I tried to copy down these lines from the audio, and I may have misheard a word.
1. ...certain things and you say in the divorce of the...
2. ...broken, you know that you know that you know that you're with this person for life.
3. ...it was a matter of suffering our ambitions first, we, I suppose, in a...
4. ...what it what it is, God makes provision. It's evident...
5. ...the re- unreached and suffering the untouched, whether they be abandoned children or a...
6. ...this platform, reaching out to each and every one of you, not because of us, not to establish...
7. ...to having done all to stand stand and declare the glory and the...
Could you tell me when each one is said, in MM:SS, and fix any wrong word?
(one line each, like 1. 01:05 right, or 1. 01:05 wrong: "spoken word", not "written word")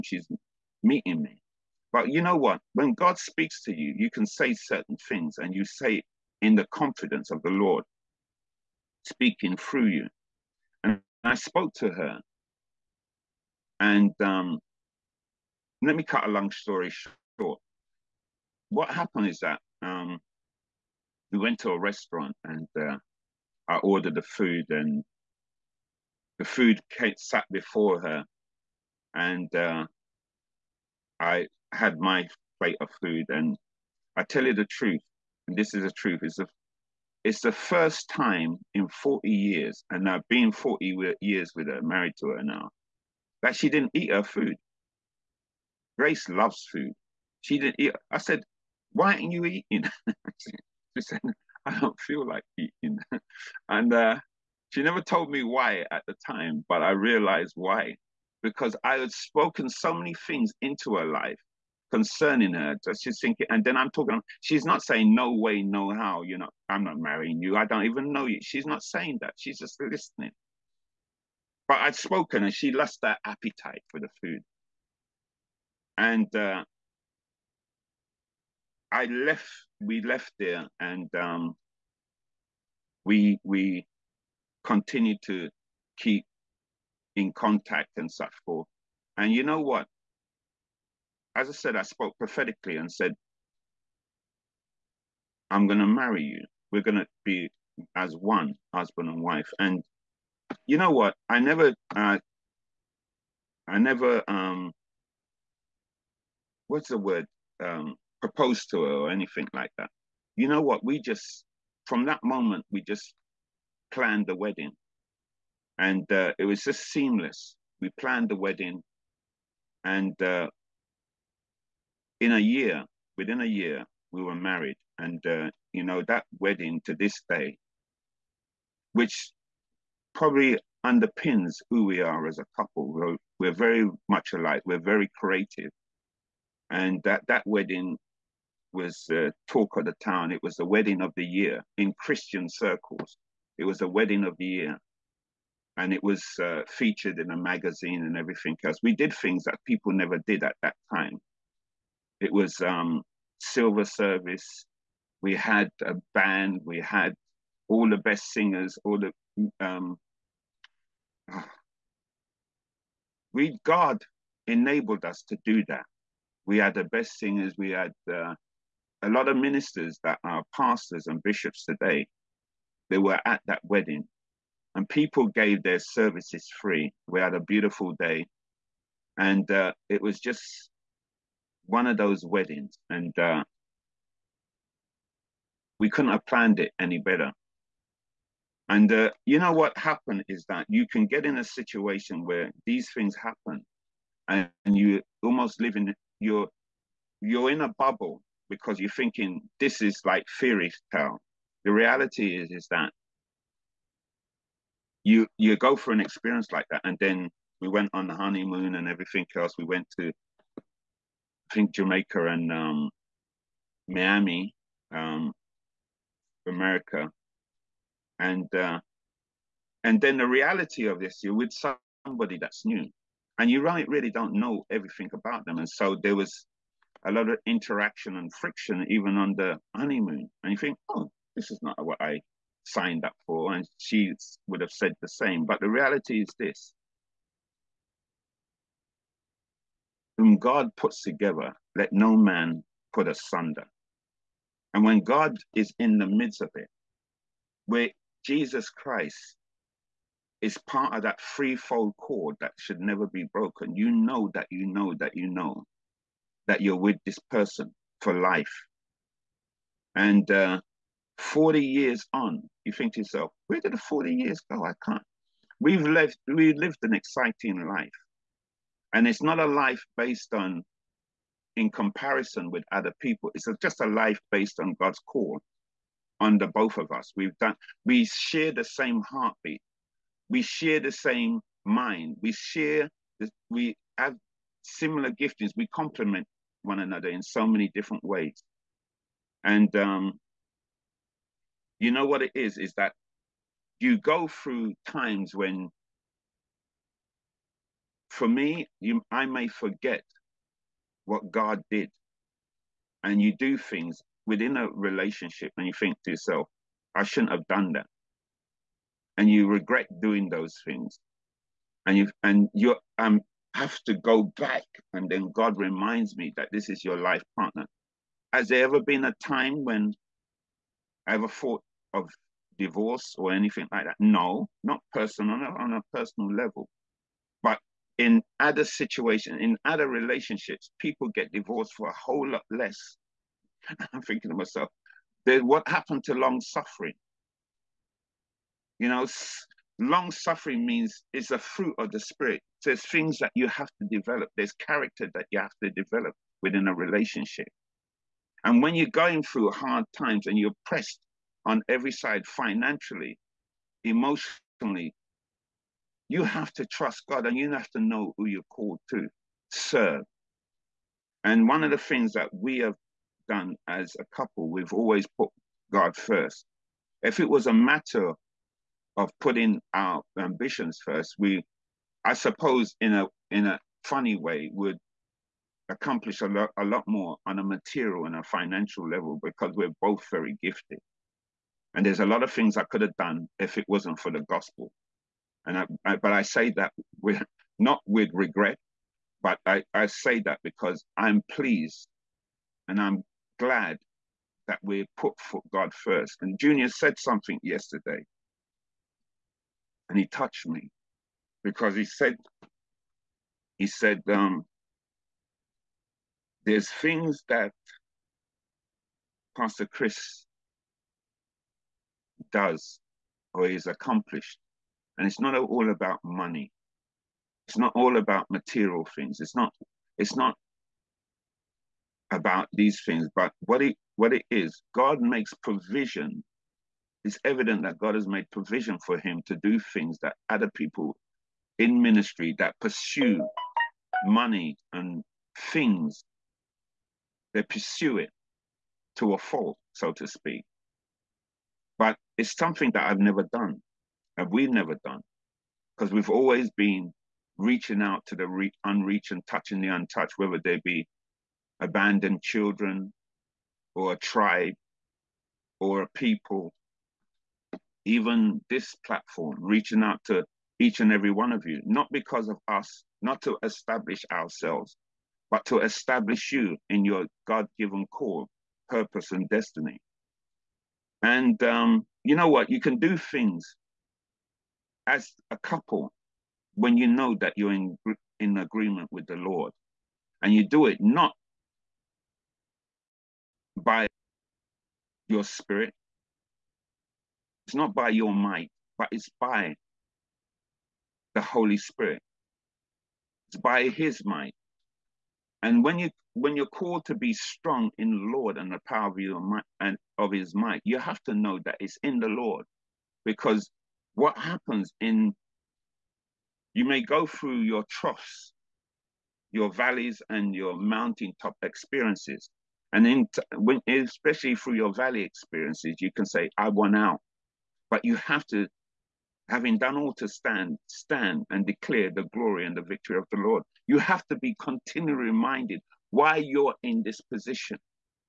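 1. 00:04 wrong: "confidence", not "divorce"
2. 04:13 right
3. 06:07 wrong: "putting", not "suffering"
4. 07:03 right
5. 07:28 wrong: "touching", not "suffering"
6. 07:38 right
7. 08:38 right.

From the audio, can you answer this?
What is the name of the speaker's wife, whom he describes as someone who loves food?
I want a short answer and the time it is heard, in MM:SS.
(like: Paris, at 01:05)
Grace, at 00:45.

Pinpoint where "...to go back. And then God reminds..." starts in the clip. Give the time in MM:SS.
05:13.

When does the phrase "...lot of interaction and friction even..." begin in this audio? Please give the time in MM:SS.
03:47.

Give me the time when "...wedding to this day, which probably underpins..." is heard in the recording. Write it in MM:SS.
02:06.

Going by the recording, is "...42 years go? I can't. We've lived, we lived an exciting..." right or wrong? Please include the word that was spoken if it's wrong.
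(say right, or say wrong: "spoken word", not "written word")
wrong: "40", not "42".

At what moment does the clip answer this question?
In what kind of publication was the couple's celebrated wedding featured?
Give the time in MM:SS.
02:27.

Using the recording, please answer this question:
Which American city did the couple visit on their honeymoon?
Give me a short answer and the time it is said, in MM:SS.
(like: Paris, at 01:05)
Miami, at 03:33.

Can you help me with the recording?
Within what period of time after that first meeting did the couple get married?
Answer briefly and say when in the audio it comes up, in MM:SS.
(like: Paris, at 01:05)
within a year, at 02:03.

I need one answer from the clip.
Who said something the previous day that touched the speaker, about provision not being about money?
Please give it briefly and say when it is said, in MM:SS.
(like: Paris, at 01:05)
Junior, at 06:36.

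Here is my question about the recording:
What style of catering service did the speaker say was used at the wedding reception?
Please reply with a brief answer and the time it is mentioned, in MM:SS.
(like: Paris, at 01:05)
silver service, at 02:33.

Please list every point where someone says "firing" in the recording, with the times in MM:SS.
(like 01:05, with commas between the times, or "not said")
not said.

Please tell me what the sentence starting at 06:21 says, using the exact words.
And there's a lot of things I could have done if it wasn't for the gospel.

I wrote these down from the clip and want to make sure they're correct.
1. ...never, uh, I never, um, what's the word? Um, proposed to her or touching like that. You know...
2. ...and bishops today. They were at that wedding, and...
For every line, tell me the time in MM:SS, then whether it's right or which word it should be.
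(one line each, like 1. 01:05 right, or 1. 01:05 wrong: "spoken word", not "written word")
1. 01:41 wrong: "anything", not "touching"
2. 02:51 right.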